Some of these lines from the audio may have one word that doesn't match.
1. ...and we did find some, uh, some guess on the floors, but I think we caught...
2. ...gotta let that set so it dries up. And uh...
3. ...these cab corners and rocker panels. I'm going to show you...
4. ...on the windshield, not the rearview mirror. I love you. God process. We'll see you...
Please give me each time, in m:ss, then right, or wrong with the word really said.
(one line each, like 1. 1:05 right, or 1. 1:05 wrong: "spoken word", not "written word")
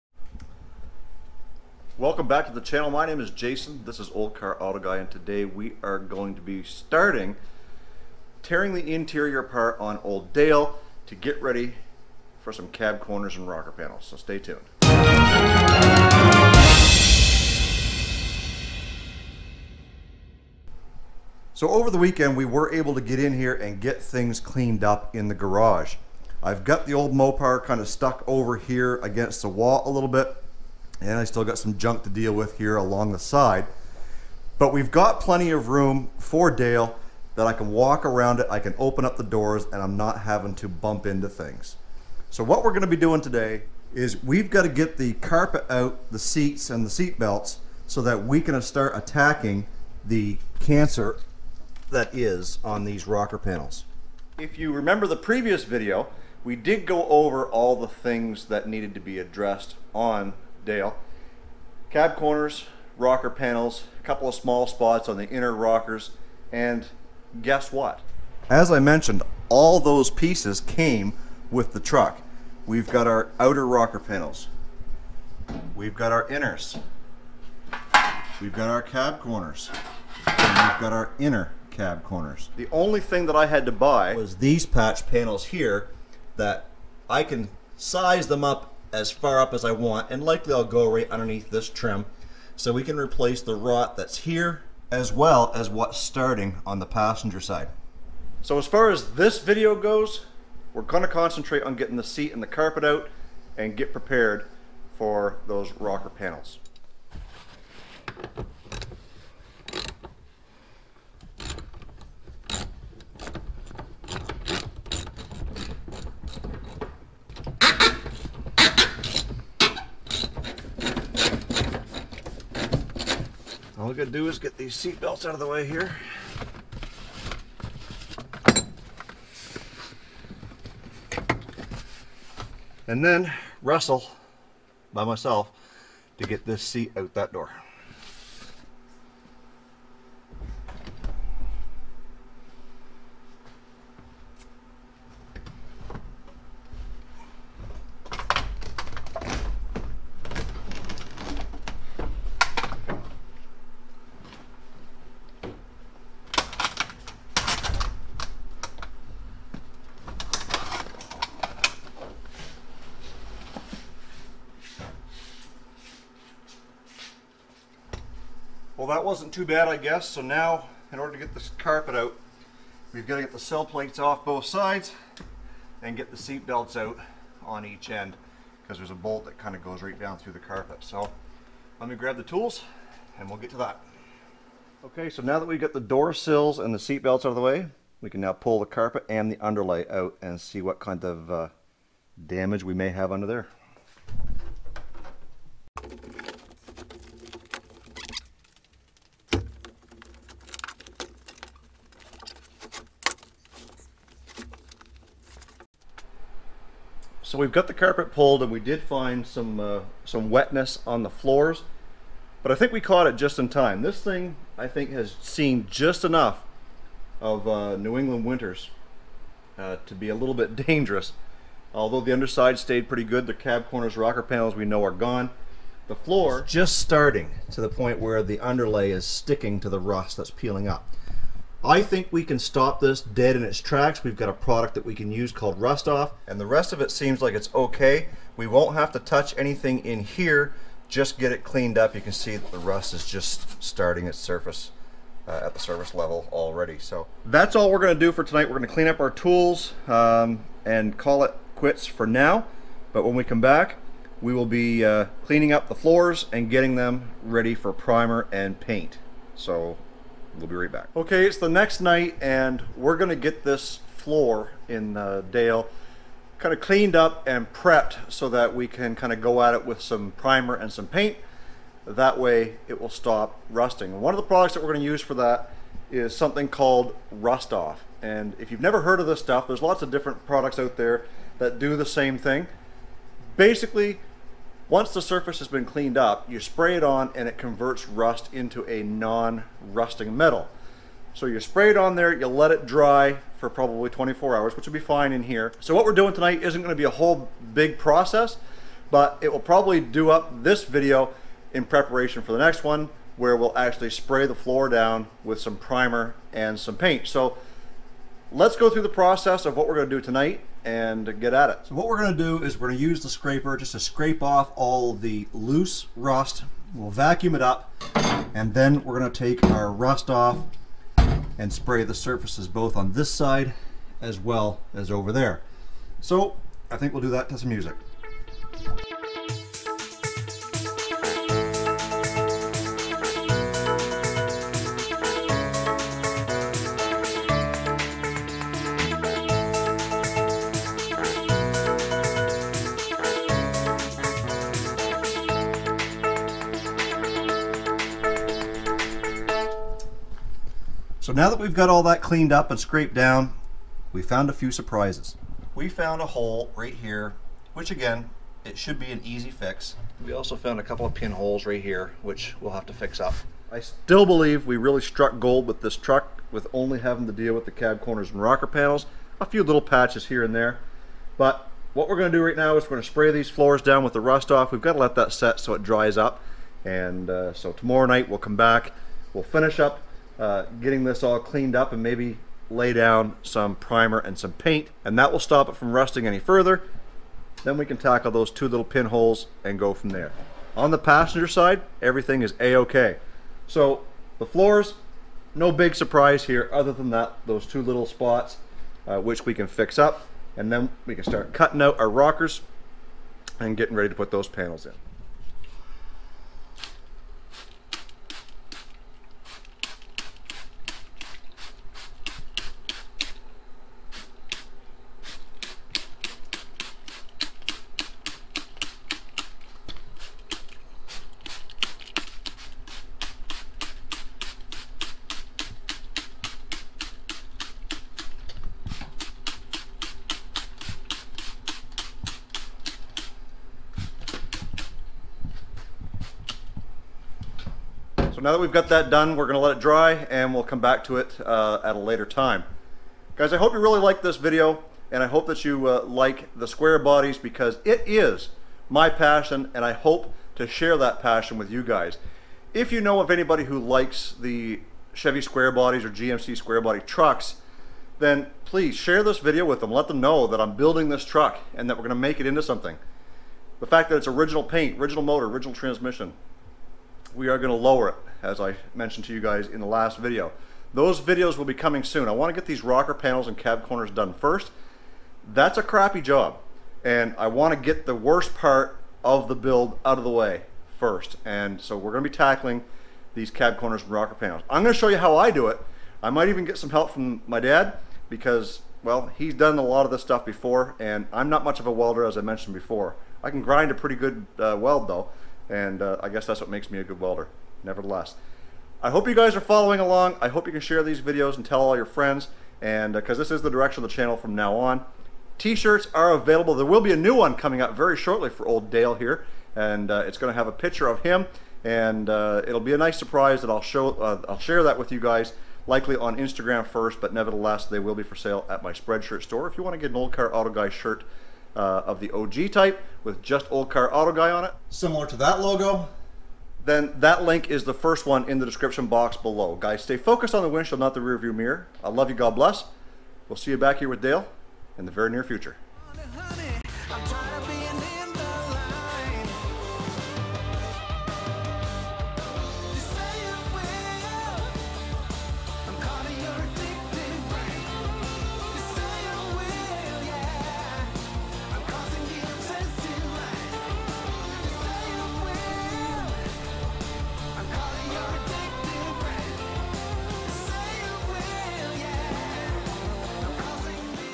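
1. 3:28 wrong: "wetness", not "guess"
2. 6:14 right
3. 8:03 right
4. 8:50 wrong: "bless", not "process".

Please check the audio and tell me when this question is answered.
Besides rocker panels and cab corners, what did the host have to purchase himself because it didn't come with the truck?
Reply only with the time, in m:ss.
1:24.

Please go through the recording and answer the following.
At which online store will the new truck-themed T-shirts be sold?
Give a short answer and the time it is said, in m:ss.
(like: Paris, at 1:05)
Spreadshirt, at 8:38.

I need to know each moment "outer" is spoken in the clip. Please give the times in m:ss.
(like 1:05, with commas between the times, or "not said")
1:13.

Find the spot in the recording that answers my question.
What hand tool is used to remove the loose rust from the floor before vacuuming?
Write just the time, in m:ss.
5:13.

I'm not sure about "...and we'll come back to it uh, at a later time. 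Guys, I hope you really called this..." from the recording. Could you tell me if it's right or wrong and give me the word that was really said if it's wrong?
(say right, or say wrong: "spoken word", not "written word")
wrong: "liked", not "called".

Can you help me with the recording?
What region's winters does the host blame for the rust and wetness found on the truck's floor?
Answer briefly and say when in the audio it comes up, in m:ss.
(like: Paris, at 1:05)
New England, at 3:37.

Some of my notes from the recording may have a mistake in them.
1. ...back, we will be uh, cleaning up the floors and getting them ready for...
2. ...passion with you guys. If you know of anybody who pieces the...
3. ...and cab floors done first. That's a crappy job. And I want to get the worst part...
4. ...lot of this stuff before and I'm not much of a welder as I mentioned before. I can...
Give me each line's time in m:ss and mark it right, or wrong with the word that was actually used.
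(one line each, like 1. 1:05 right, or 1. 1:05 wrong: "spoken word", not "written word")
1. 4:13 right
2. 7:31 wrong: "likes", not "pieces"
3. 7:53 wrong: "corners", not "floors"
4. 8:09 right.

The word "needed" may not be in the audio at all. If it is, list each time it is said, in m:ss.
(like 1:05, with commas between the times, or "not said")
0:58.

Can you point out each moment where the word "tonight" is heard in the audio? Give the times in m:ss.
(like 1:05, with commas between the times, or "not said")
4:08, 4:56, 5:09.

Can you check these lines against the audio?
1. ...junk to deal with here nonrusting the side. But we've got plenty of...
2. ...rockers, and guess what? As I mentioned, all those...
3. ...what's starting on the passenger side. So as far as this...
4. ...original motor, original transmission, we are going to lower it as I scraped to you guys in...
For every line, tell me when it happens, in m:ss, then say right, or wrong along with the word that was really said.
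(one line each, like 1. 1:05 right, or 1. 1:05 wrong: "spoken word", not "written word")
1. 0:31 wrong: "along", not "nonrusting"
2. 1:05 right
3. 1:35 right
4. 7:44 wrong: "mentioned", not "scraped".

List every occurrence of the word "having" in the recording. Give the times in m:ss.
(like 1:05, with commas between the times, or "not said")
0:40, 6:06.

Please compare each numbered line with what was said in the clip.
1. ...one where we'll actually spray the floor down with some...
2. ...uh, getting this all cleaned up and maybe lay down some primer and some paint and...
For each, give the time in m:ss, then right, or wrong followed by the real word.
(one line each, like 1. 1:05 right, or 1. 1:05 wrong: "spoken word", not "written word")
1. 5:02 right
2. 6:20 right.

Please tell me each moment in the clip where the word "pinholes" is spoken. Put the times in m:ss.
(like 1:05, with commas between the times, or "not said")
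6:00, 6:28.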